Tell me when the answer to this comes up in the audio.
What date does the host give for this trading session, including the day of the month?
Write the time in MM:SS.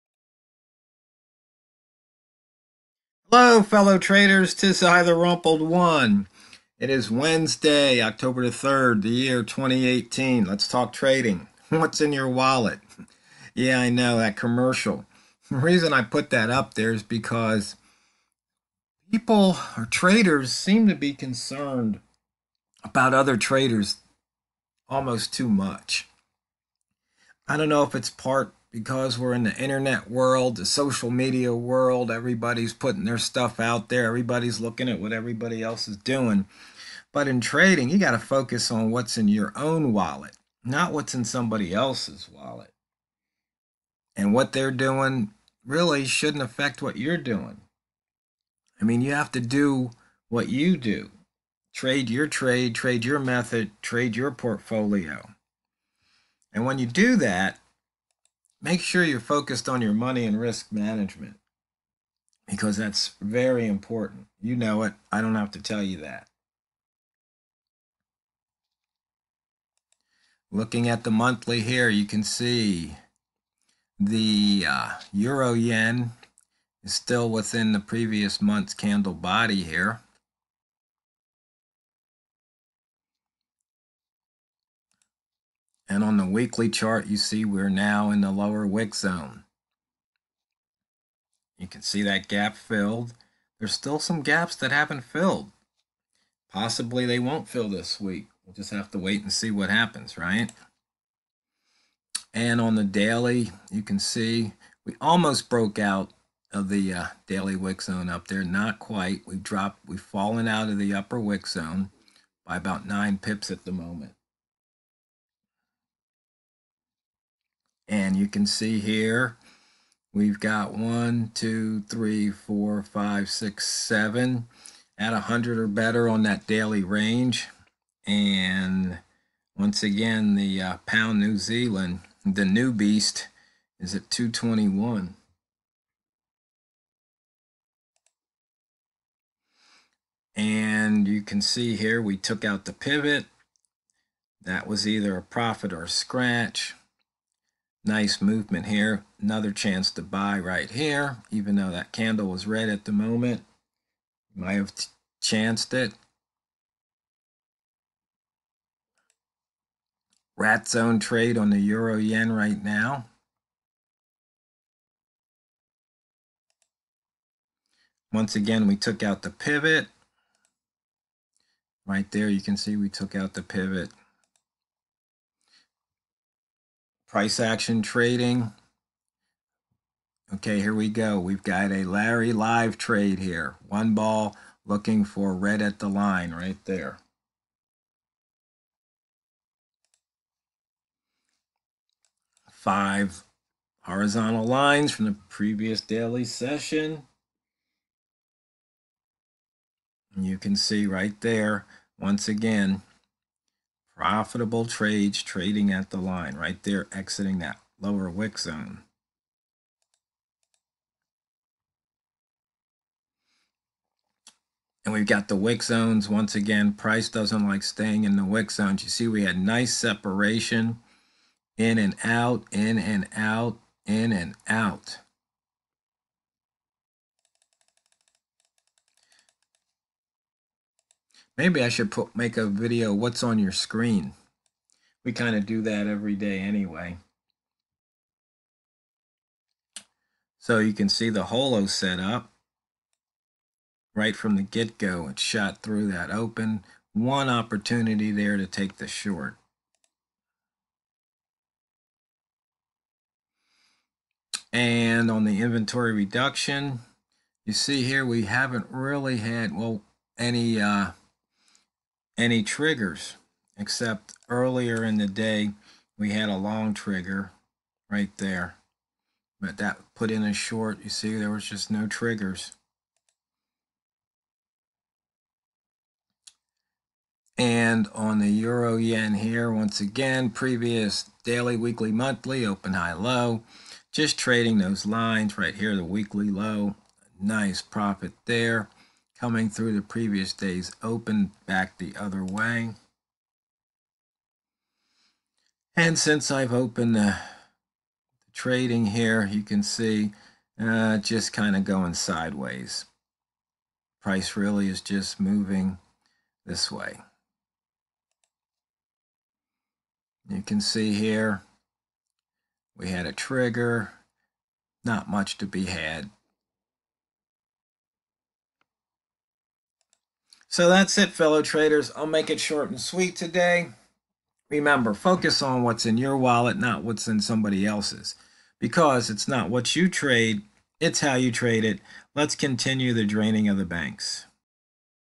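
00:08.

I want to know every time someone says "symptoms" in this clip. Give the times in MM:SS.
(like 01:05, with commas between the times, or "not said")
not said.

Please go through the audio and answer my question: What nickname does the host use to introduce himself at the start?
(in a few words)
the Rumpled One.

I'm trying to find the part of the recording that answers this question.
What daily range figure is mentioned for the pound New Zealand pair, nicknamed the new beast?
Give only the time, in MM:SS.
02:14.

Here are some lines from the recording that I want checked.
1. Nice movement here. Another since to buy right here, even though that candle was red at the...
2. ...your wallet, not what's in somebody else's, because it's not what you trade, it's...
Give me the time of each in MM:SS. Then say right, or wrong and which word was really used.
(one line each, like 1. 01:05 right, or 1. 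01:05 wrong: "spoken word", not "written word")
1. 02:27 wrong: "chance", not "since"
2. 05:25 right.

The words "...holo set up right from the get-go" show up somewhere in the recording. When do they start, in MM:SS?
04:01.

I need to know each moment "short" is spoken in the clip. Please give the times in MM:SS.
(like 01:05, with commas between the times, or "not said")
04:08, 04:30, 05:22.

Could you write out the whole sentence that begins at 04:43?
Just trading those lines right here, the weekly low.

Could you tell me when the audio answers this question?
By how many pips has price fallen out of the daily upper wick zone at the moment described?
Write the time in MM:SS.
01:52.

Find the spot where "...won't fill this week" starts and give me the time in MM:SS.
01:37.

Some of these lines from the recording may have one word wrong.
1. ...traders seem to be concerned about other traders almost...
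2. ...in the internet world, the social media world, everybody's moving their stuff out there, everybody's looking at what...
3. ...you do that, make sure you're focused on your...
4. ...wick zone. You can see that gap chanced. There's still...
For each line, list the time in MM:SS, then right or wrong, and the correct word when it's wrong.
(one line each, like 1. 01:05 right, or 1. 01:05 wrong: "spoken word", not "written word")
1. 00:19 right
2. 00:29 wrong: "putting", not "moving"
3. 00:56 right
4. 01:28 wrong: "filled", not "chanced".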